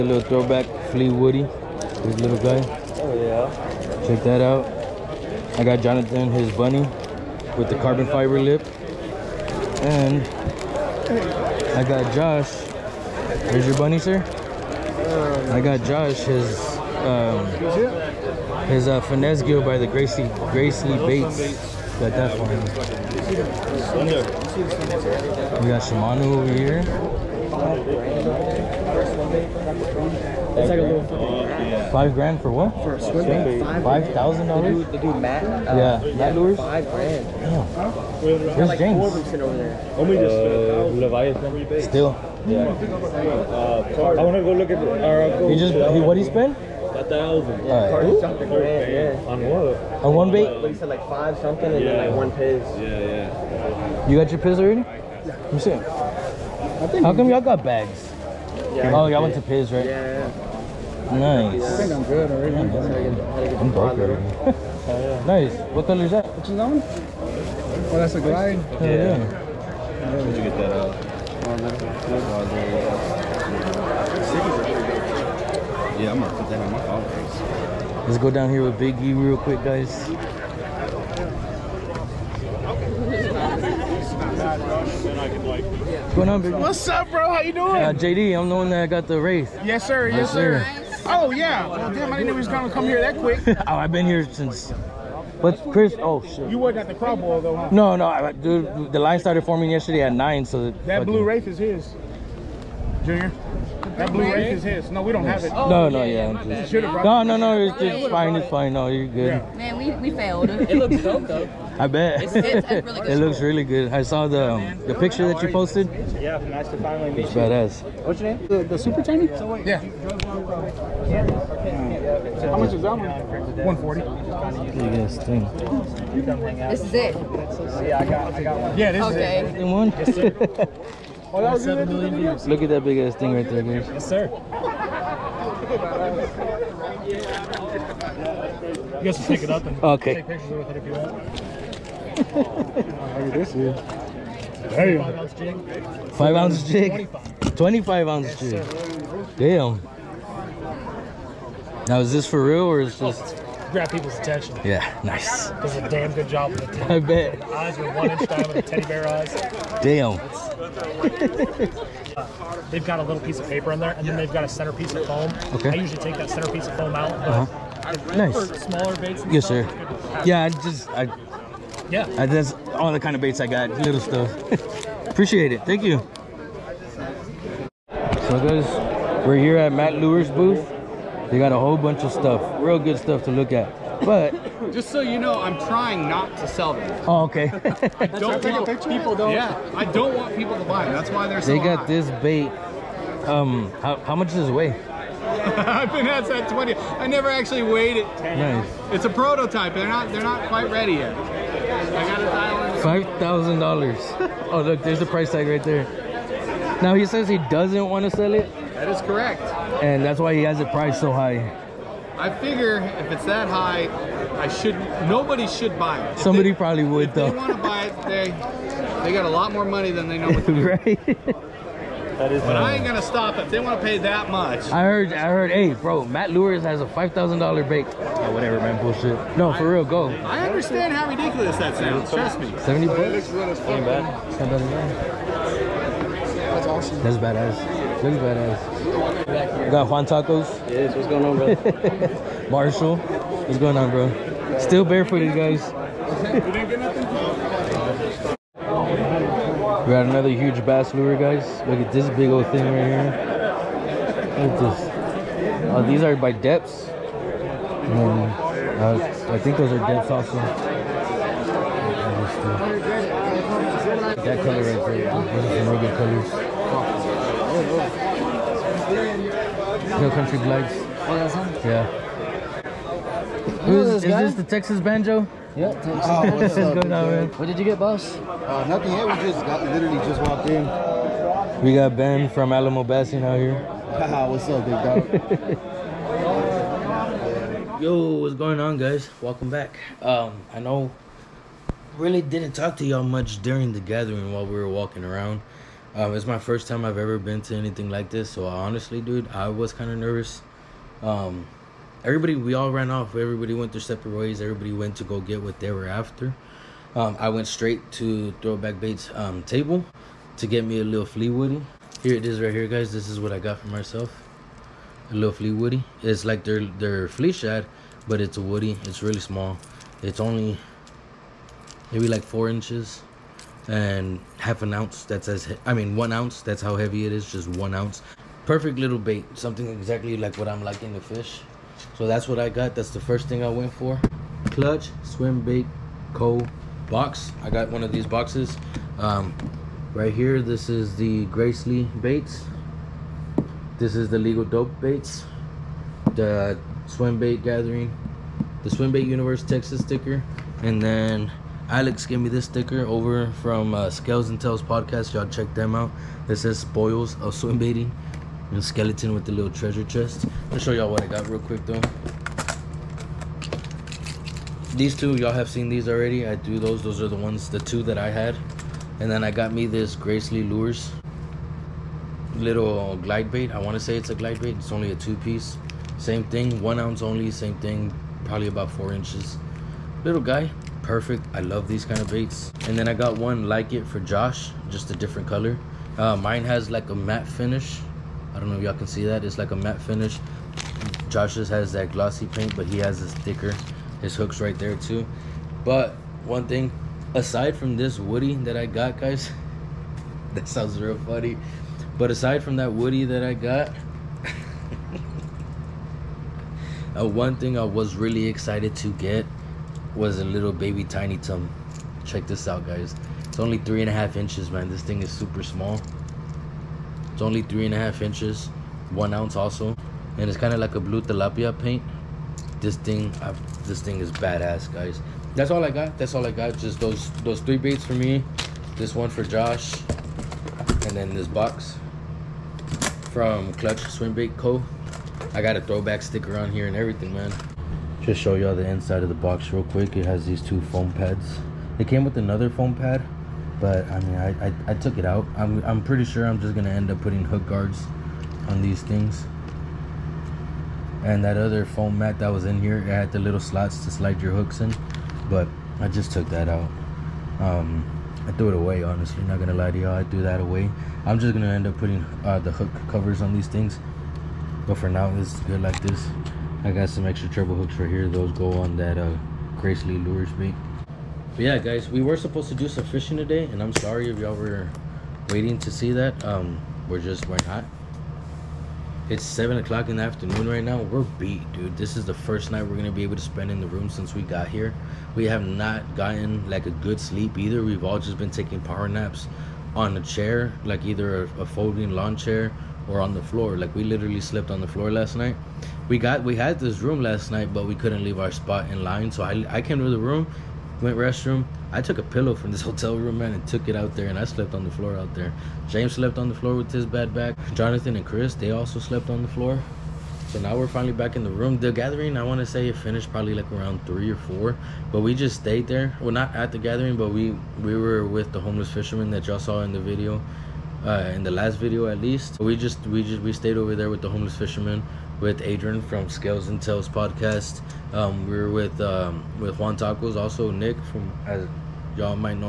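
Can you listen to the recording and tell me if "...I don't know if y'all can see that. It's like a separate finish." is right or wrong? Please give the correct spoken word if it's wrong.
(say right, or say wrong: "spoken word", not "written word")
wrong: "matte", not "separate".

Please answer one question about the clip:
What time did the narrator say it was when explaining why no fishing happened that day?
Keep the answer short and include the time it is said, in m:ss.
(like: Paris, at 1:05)
7 o'clock, at 7:59.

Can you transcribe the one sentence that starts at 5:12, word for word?
here it is right here guys this is what i got for myself a little flea woody.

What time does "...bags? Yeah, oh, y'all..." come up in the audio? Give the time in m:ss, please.
0:57.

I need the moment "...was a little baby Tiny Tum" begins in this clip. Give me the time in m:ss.
6:49.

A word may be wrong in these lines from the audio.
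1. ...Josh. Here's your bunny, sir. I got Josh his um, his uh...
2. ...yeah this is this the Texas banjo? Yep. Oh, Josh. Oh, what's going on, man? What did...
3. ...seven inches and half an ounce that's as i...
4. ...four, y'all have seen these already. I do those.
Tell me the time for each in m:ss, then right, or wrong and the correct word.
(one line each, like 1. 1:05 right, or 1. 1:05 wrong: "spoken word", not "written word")
1. 0:12 right
2. 4:31 wrong: "Texas", not "Josh"
3. 5:22 wrong: "four", not "seven"
4. 6:04 wrong: "two", not "four".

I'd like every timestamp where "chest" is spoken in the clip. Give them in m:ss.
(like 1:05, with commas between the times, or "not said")
5:59.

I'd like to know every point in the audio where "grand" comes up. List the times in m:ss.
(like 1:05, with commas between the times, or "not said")
0:32, 0:36, 0:48.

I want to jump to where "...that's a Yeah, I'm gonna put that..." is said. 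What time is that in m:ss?
1:11.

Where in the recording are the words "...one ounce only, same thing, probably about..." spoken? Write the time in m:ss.
6:16.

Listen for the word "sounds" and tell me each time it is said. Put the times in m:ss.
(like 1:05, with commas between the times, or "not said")
3:51, 6:40.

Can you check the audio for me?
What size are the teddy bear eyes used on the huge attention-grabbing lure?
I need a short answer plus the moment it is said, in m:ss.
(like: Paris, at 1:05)
1 inch diameter, at 2:37.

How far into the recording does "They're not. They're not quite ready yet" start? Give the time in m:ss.
3:19.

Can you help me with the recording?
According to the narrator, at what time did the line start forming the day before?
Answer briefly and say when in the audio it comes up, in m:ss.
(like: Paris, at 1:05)
9, at 1:40.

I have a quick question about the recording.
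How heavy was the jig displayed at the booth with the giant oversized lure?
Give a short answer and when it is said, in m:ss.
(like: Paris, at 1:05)
25 ounce, at 2:27.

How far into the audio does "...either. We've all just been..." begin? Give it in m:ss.
8:07.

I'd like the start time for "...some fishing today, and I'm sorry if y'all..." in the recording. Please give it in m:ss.
7:52.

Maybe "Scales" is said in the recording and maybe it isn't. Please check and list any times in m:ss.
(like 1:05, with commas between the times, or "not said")
5:53, 8:46.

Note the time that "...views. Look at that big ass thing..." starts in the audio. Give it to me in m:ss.
2:12.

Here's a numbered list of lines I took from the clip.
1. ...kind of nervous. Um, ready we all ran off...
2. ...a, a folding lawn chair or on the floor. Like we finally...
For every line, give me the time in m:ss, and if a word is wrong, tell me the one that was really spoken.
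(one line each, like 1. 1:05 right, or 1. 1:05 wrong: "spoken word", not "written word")
1. 4:59 wrong: "everybody", not "ready"
2. 8:11 wrong: "literally", not "finally".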